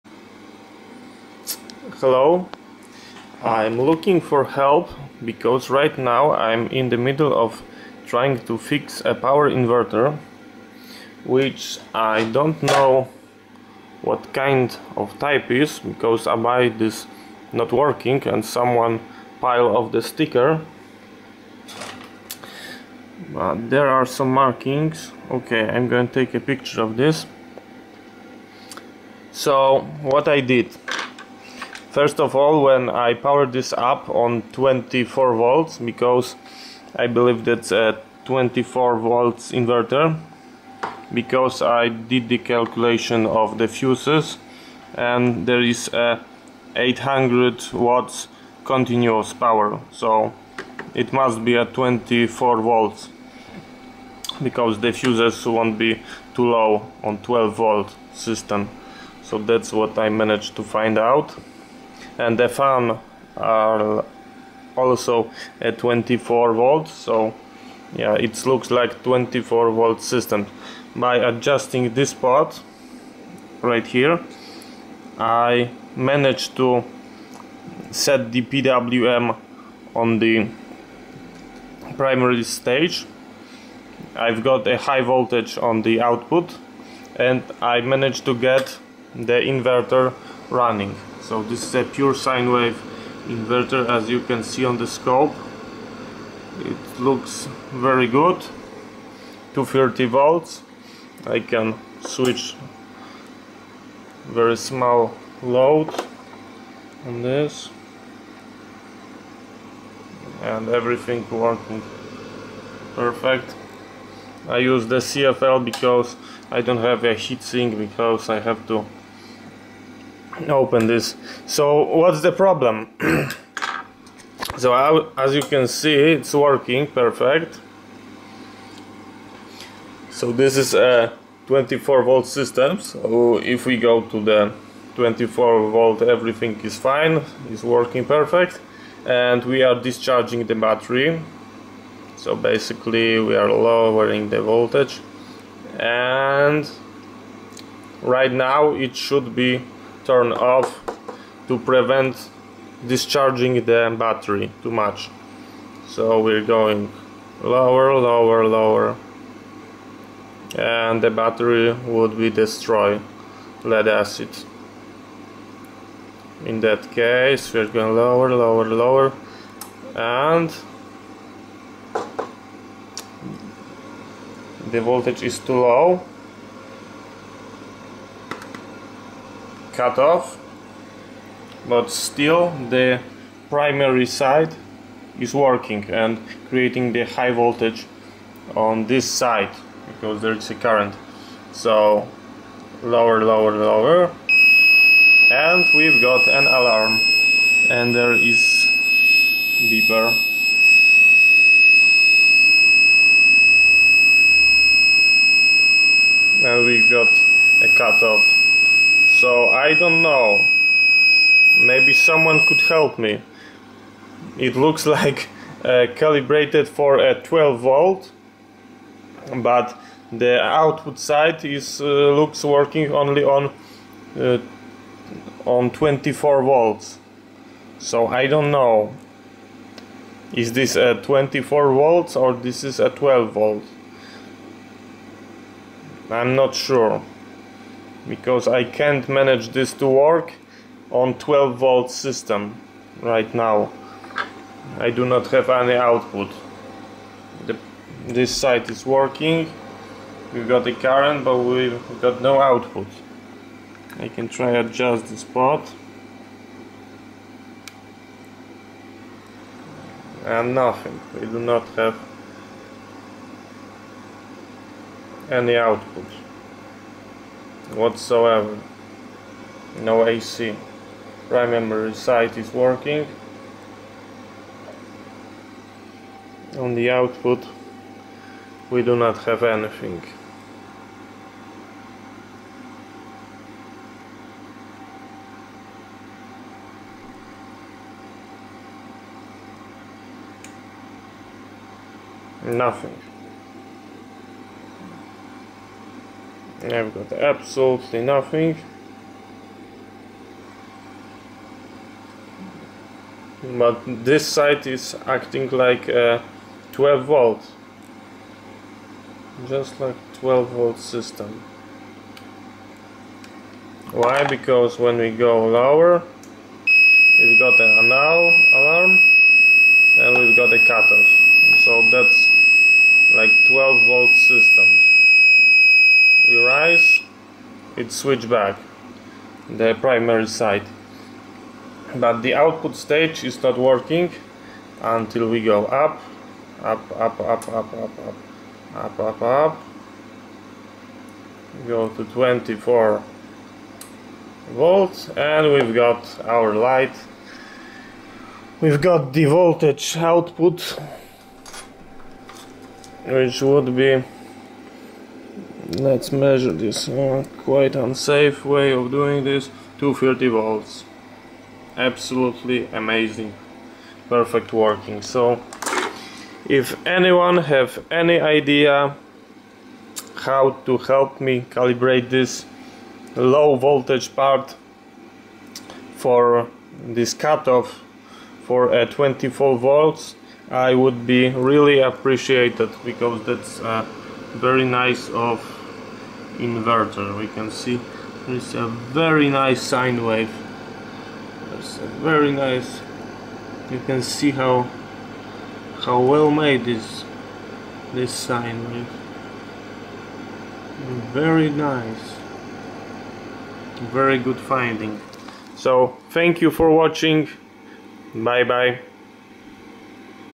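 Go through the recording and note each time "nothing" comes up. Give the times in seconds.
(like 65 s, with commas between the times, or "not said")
260 s, 292 s, 298 s.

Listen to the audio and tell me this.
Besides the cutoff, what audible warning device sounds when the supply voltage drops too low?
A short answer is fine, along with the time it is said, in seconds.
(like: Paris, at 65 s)
Beeper, at 199 s.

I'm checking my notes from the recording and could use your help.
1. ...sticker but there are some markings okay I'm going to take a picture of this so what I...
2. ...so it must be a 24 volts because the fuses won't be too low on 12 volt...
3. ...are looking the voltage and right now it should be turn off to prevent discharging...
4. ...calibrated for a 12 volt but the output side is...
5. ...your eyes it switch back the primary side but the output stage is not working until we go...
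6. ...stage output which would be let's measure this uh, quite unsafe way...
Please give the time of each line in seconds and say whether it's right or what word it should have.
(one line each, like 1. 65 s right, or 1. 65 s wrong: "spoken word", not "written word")
1. 20 s right
2. 49 s right
3. 143 s wrong: "lowering", not "looking"
4. 215 s right
5. 326 s right
6. 349 s wrong: "voltage", not "stage".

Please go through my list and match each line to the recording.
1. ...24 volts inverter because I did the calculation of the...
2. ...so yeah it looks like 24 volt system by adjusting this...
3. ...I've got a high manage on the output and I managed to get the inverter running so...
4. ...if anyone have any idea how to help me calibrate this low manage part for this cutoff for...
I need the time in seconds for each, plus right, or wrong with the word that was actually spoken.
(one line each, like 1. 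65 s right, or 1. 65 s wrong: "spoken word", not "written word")
1. 38 s right
2. 66 s right
3. 84 s wrong: "voltage", not "manage"
4. 366 s wrong: "voltage", not "manage".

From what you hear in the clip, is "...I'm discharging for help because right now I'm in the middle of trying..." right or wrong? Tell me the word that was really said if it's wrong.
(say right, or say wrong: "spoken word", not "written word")
wrong: "looking", not "discharging".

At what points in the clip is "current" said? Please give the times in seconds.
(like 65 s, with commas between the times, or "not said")
190 s, 250 s.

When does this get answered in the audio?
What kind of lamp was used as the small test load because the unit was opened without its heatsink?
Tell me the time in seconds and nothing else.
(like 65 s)
115 s.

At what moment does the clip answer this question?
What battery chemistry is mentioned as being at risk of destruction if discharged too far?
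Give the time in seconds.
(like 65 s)
163 s.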